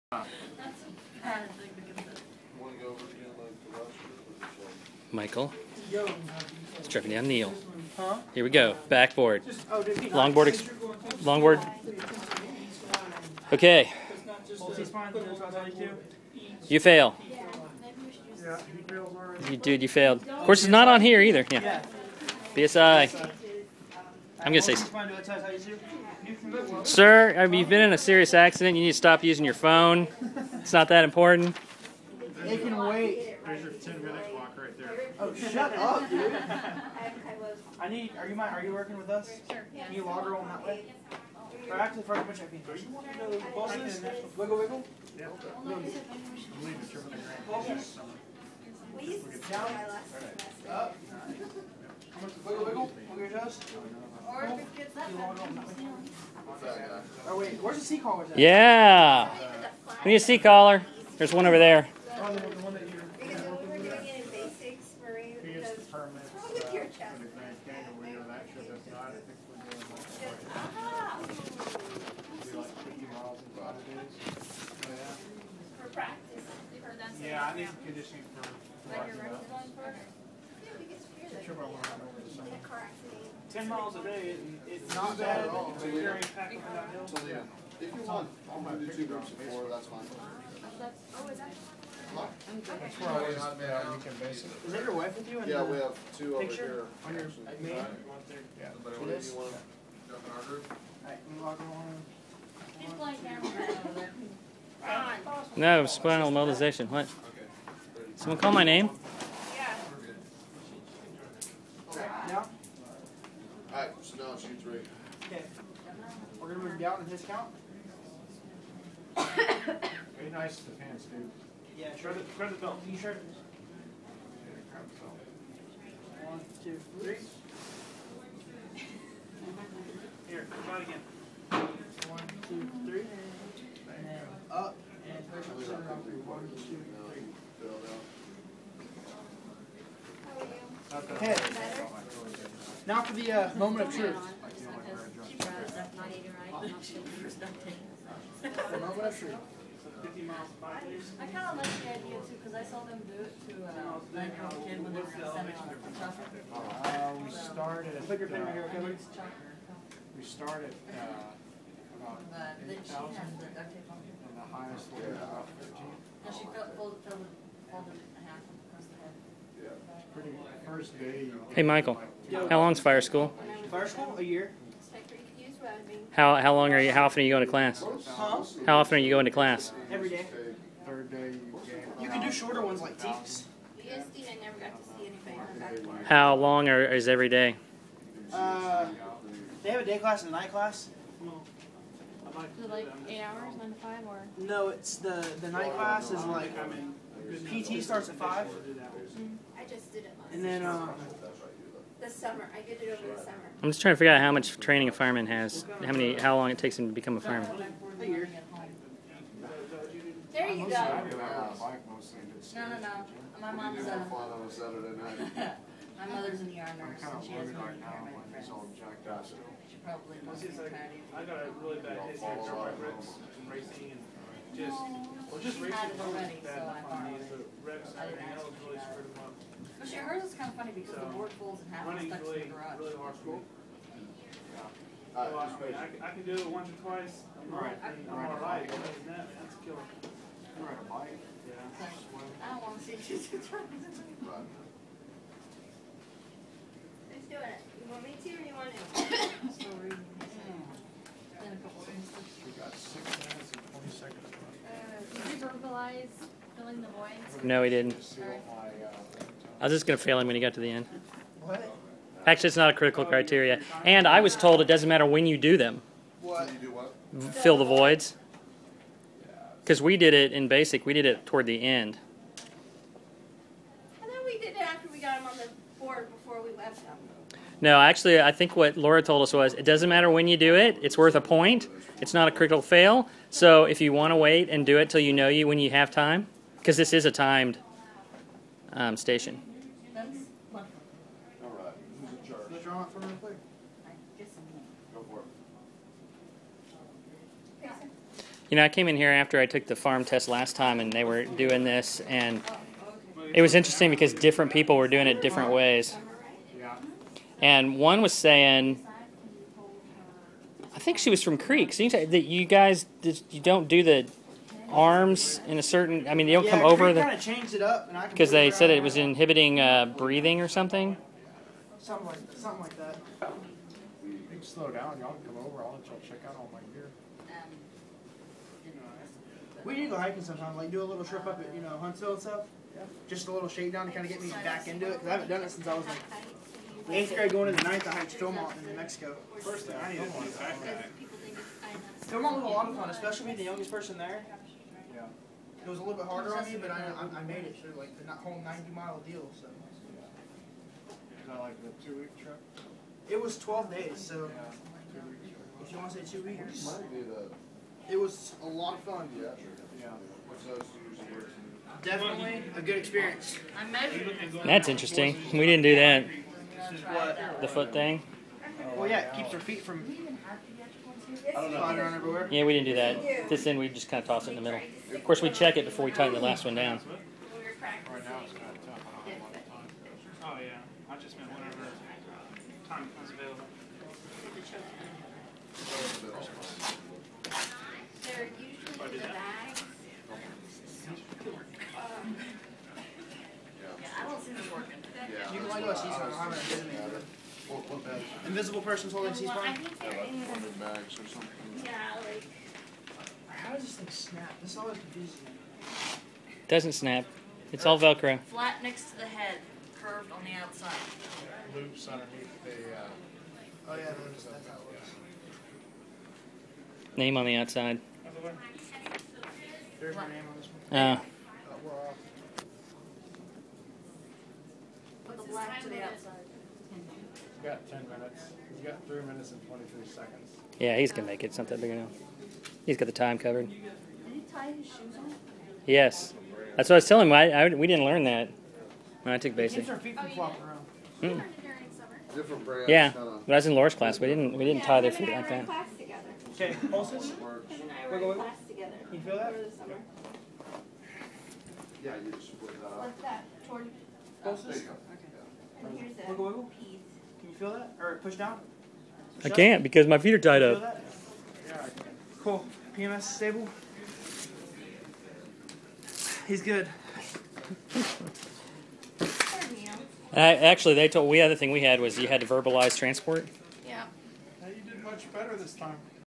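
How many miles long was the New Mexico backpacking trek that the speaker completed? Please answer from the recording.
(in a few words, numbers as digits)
90.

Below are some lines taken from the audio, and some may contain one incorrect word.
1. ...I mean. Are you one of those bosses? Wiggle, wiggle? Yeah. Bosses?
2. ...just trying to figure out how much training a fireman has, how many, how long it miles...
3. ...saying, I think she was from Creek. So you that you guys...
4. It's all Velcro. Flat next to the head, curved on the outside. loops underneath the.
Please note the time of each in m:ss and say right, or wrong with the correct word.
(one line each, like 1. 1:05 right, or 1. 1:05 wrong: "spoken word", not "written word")
1. 0:42 right
2. 3:23 wrong: "takes", not "miles"
3. 5:08 right
4. 6:47 right.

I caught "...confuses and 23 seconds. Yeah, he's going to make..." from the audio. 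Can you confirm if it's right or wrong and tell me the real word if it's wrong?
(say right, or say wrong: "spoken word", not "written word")
wrong: "minutes", not "confuses".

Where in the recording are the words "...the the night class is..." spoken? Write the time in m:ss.
3:14.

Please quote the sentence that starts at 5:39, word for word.
First thing I needed to do is Philmont was a lot of fun, especially being the youngest person there.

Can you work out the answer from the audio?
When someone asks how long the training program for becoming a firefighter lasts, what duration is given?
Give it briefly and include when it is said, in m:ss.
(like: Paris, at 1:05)
A year, at 2:54.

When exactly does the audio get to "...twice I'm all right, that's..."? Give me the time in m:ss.
3:56.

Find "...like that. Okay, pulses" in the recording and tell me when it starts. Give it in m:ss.
7:25.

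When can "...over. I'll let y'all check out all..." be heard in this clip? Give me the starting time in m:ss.
5:25.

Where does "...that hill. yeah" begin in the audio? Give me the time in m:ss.
1:27.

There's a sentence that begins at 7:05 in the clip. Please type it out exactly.
Put the black to the outside.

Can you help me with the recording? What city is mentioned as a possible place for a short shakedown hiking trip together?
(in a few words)
Huntsville.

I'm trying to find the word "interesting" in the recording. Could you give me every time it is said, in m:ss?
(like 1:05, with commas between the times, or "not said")
5:03, 6:04.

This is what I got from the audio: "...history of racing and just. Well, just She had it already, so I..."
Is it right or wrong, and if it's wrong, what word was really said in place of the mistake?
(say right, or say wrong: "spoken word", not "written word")
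right.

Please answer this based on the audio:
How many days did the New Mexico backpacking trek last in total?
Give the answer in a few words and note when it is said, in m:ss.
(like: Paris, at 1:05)
12, at 5:53.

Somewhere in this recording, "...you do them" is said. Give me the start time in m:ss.
4:25.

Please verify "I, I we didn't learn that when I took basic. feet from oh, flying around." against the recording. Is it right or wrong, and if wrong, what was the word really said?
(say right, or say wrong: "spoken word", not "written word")
wrong: "flopping", not "flying".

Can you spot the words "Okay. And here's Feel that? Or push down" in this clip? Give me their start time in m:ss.
7:34.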